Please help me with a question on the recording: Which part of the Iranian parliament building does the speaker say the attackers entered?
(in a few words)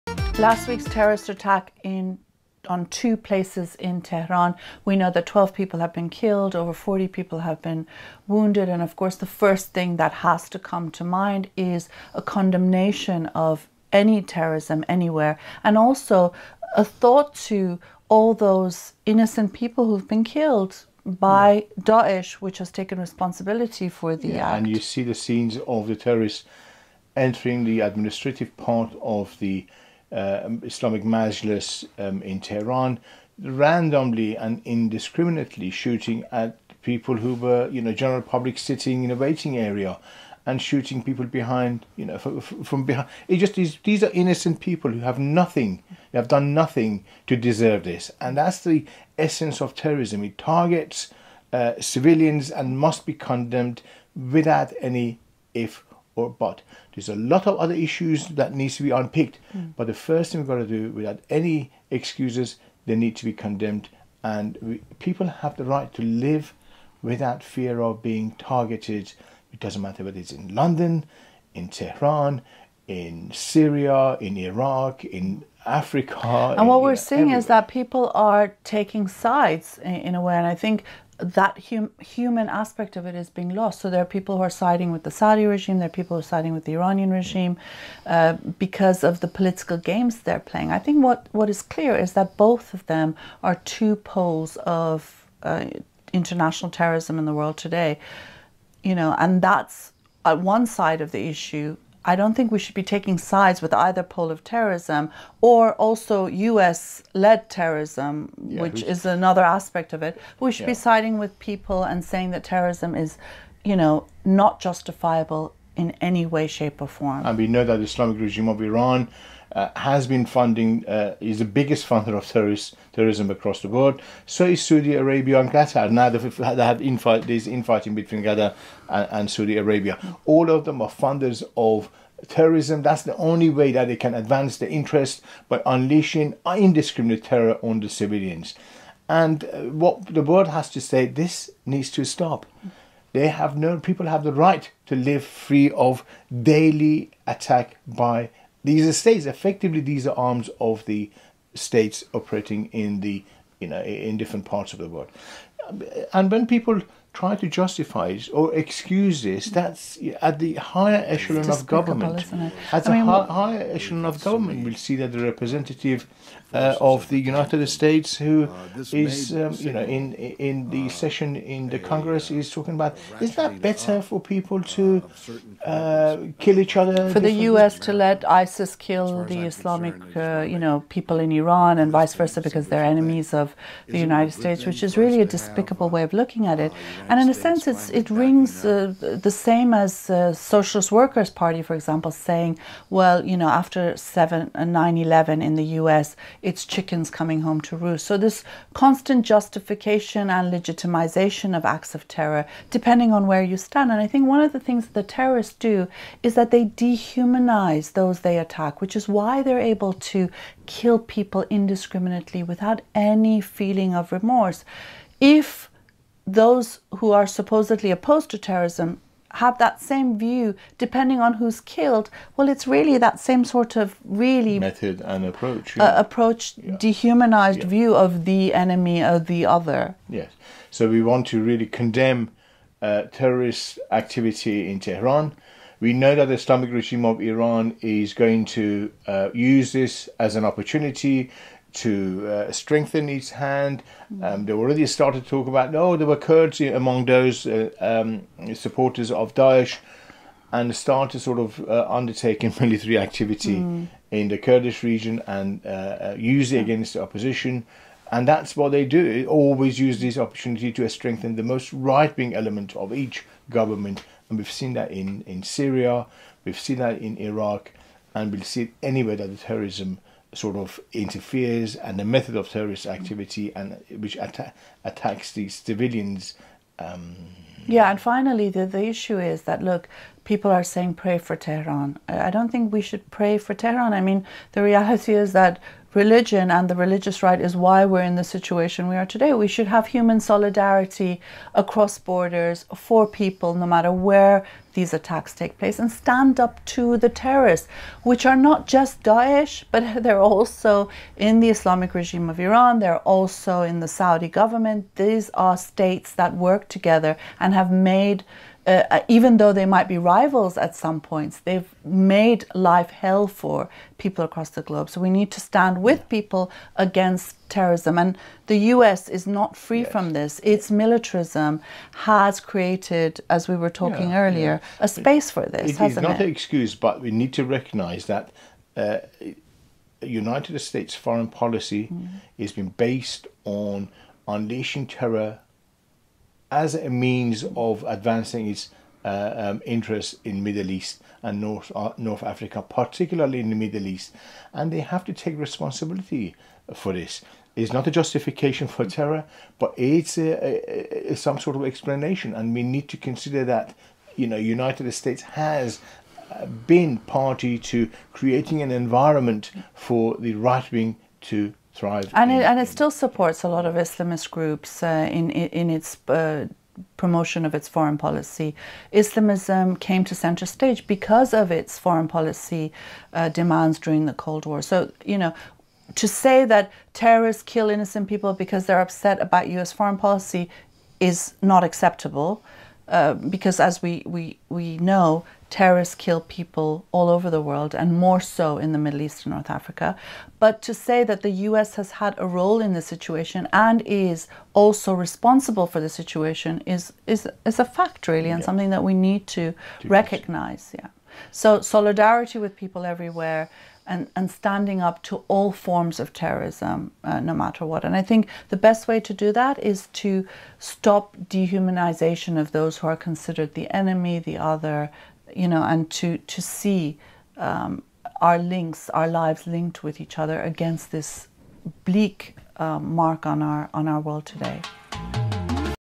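The administrative part.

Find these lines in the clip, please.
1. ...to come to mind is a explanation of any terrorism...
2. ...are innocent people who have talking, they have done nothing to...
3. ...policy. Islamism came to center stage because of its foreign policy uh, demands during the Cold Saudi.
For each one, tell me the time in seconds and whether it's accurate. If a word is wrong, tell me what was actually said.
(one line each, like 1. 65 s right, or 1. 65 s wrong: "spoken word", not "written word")
1. 10 s wrong: "condemnation", not "explanation"
2. 44 s wrong: "nothing", not "talking"
3. 367 s wrong: "War", not "Saudi".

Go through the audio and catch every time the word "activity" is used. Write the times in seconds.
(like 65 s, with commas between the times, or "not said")
233 s, 252 s, 272 s.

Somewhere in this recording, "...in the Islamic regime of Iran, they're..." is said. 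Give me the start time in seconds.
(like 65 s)
301 s.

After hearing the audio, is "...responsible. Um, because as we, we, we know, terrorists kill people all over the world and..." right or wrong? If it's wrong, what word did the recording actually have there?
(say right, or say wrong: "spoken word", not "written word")
wrong: "acceptable", not "responsible".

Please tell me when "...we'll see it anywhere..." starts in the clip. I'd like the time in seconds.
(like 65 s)
268 s.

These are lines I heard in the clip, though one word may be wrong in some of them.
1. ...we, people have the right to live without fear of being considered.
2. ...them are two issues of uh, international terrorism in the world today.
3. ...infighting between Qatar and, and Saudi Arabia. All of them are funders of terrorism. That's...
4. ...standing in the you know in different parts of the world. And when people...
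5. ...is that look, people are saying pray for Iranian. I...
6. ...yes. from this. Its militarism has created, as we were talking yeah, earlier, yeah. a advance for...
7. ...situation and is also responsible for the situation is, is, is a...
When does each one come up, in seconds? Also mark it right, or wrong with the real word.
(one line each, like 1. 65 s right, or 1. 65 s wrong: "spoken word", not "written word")
1. 64 s wrong: "targeted", not "considered"
2. 92 s wrong: "poles", not "issues"
3. 127 s right
4. 152 s wrong: "operating", not "standing"
5. 279 s wrong: "Tehran", not "Iranian"
6. 319 s wrong: "space", not "advance"
7. 392 s right.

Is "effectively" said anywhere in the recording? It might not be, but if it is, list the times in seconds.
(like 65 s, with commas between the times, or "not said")
149 s.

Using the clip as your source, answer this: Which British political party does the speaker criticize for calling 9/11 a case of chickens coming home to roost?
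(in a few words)
Socialist Workers' Party.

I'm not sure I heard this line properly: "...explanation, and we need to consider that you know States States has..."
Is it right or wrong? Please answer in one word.
wrong.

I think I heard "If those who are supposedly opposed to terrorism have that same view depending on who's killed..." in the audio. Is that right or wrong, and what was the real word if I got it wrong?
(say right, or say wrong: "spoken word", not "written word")
right.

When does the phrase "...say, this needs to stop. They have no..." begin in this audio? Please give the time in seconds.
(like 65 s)
140 s.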